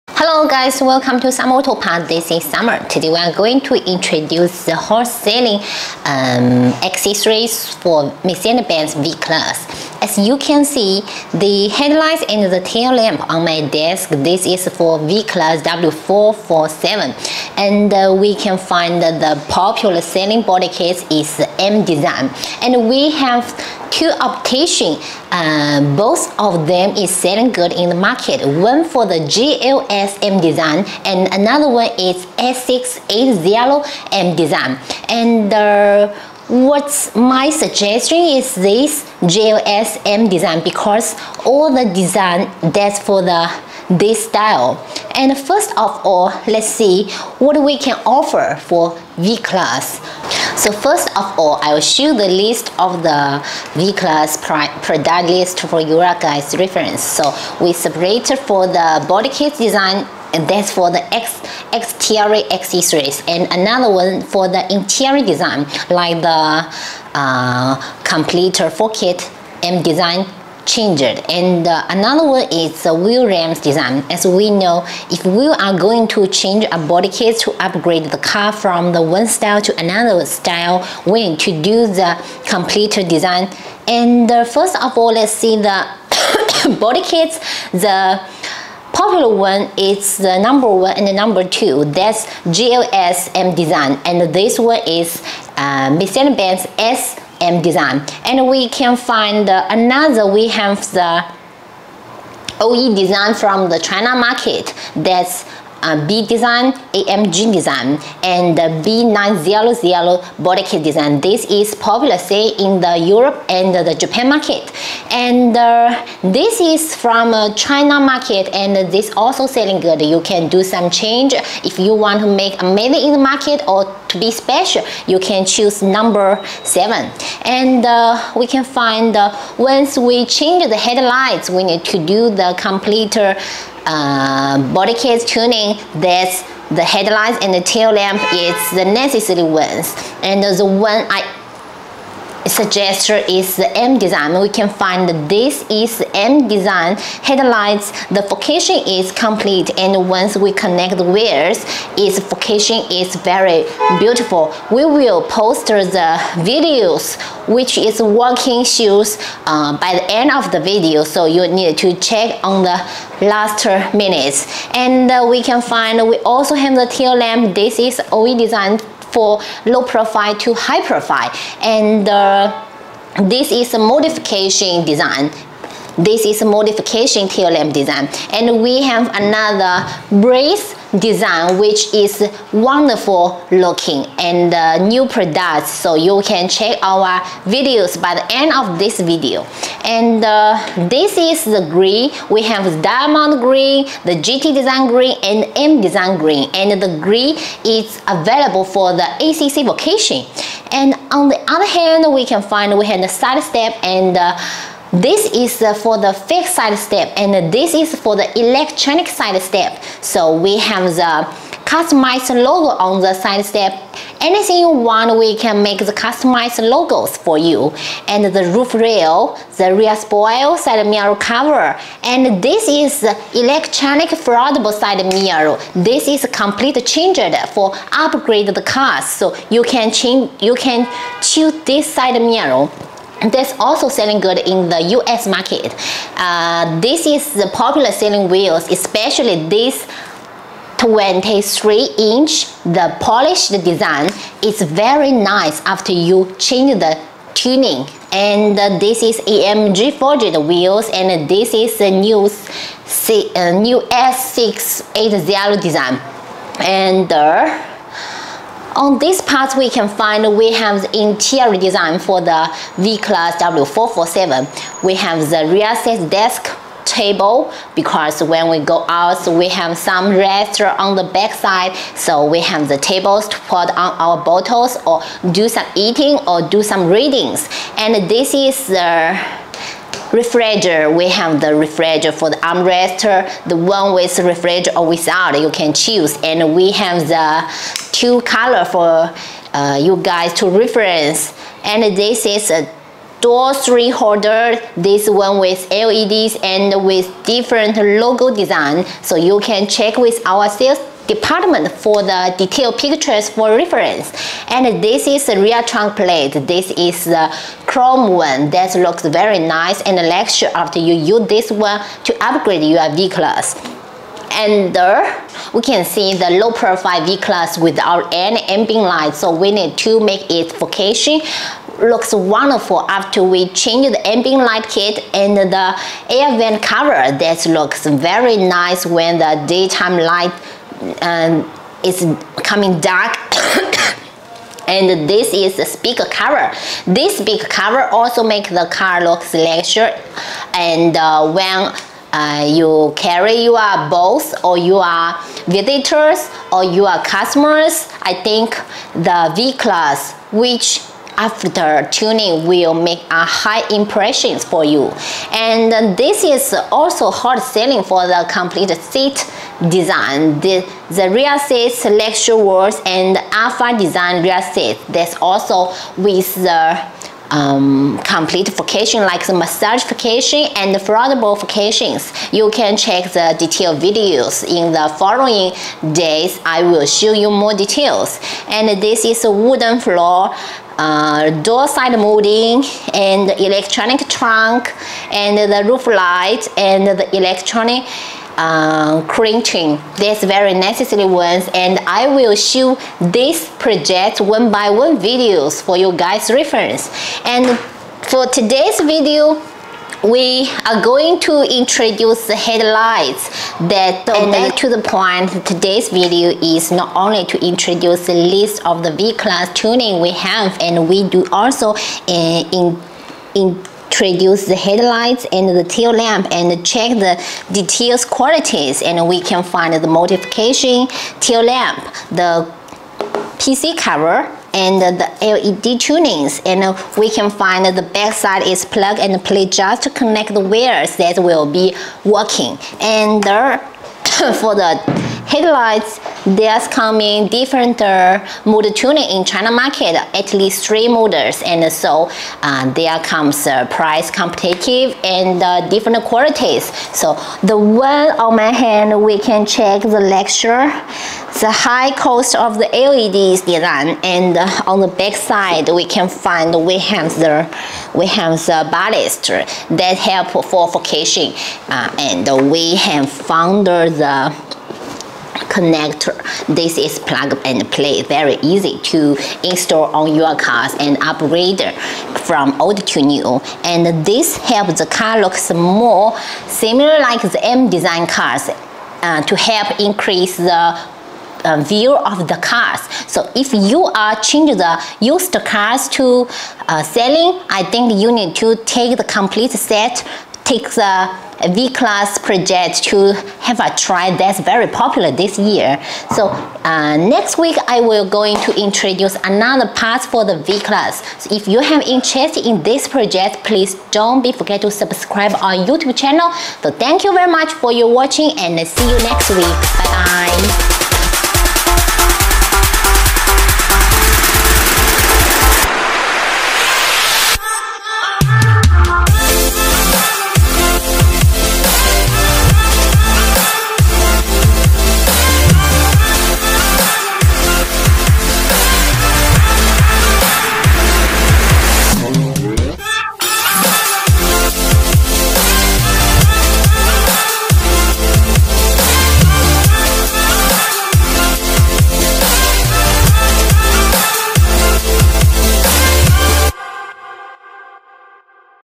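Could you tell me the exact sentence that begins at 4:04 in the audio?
It's very nice after you change the tuning.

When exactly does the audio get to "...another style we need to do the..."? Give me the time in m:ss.
1:19.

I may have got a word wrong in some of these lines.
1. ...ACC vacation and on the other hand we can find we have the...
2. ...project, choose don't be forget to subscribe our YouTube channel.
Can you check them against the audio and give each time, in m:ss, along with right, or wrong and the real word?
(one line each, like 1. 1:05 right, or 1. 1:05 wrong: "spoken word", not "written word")
1. 3:19 right
2. 8:22 wrong: "please", not "choose".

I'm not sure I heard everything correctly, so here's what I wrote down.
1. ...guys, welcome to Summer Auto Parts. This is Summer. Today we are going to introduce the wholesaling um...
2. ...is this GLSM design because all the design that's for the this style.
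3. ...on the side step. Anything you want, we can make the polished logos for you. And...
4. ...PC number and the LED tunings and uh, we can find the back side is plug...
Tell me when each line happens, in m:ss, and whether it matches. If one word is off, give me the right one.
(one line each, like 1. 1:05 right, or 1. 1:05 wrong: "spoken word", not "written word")
1. 0:00 right
2. 0:38 right
3. 3:32 wrong: "customized", not "polished"
4. 7:03 wrong: "cover", not "number".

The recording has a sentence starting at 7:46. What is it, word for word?
This is plug and play, very easy to install on your cars and upgrade from old to new.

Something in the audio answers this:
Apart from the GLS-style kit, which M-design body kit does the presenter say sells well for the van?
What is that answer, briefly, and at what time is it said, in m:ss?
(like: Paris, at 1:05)
S680M design, at 0:32.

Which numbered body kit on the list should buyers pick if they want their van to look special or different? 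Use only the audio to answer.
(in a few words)
number seven.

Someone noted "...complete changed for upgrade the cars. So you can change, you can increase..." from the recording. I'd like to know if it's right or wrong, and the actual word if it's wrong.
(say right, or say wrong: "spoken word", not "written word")
wrong: "choose", not "increase".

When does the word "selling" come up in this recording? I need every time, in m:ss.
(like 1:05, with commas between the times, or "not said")
0:20, 0:27, 1:59, 3:53, 3:57, 5:57, 8:06.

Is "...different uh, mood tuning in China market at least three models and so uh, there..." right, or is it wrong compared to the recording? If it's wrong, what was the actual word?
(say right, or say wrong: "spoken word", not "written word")
right.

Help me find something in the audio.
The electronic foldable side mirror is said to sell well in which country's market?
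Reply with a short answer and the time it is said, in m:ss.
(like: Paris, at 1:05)
US, at 3:54.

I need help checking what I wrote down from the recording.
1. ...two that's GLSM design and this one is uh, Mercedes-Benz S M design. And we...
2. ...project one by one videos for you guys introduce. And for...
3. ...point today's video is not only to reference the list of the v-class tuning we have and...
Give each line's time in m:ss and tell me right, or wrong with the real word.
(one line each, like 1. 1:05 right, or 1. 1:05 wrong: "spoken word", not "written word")
1. 1:31 right
2. 6:33 wrong: "reference", not "introduce"
3. 6:44 wrong: "introduce", not "reference".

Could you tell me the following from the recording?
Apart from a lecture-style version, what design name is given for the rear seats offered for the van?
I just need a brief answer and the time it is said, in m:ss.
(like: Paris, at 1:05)
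alpha design, at 6:03.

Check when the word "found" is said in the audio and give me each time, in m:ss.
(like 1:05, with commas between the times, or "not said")
7:43.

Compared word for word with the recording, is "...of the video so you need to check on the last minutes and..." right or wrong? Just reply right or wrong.
right.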